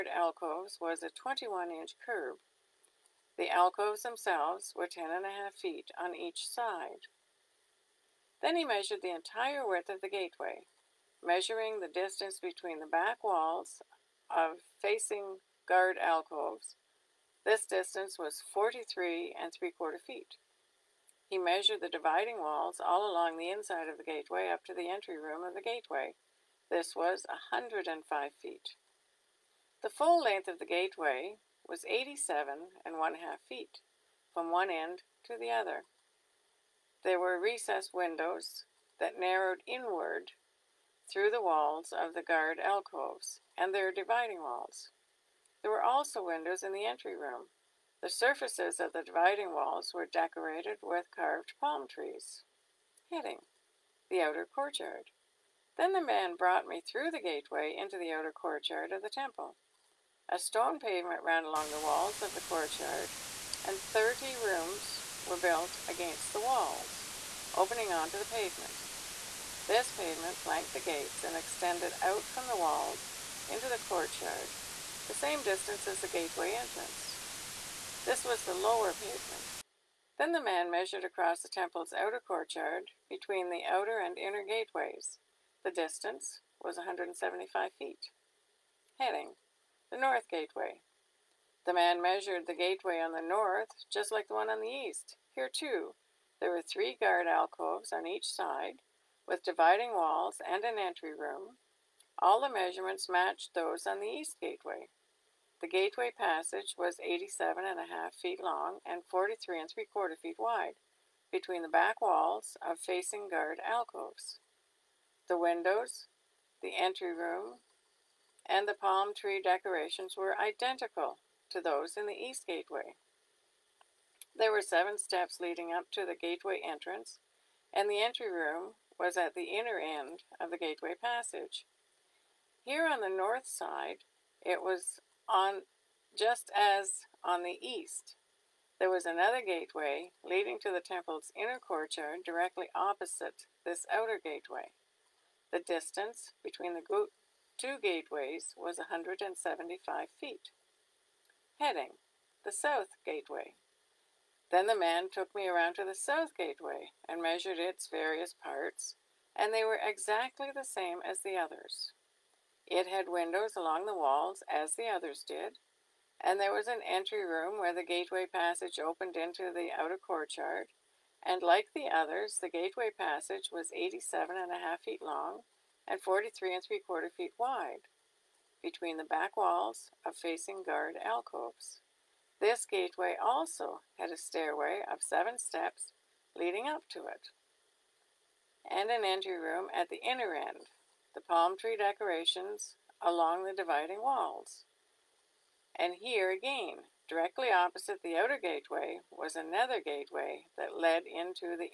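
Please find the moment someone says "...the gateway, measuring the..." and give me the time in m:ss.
0:10.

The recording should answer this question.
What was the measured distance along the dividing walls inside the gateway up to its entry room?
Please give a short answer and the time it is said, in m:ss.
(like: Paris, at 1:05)
105 feet, at 0:27.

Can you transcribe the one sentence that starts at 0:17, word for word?
This distance was 43 and three quarter feet.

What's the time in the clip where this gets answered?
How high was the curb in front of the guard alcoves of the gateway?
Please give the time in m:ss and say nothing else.
0:01.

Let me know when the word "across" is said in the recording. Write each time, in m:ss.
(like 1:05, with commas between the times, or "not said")
1:21.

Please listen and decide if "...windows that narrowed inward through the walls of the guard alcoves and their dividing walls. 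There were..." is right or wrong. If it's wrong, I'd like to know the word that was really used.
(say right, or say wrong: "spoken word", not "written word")
right.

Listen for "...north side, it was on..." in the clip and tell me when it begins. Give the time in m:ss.
2:13.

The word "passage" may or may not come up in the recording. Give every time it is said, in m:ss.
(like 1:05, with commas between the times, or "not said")
1:46, 2:11, 2:48, 2:52.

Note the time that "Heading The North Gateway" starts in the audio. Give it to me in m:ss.
1:28.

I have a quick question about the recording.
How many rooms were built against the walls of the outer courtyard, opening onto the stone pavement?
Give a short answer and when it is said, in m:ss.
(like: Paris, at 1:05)
30, at 1:03.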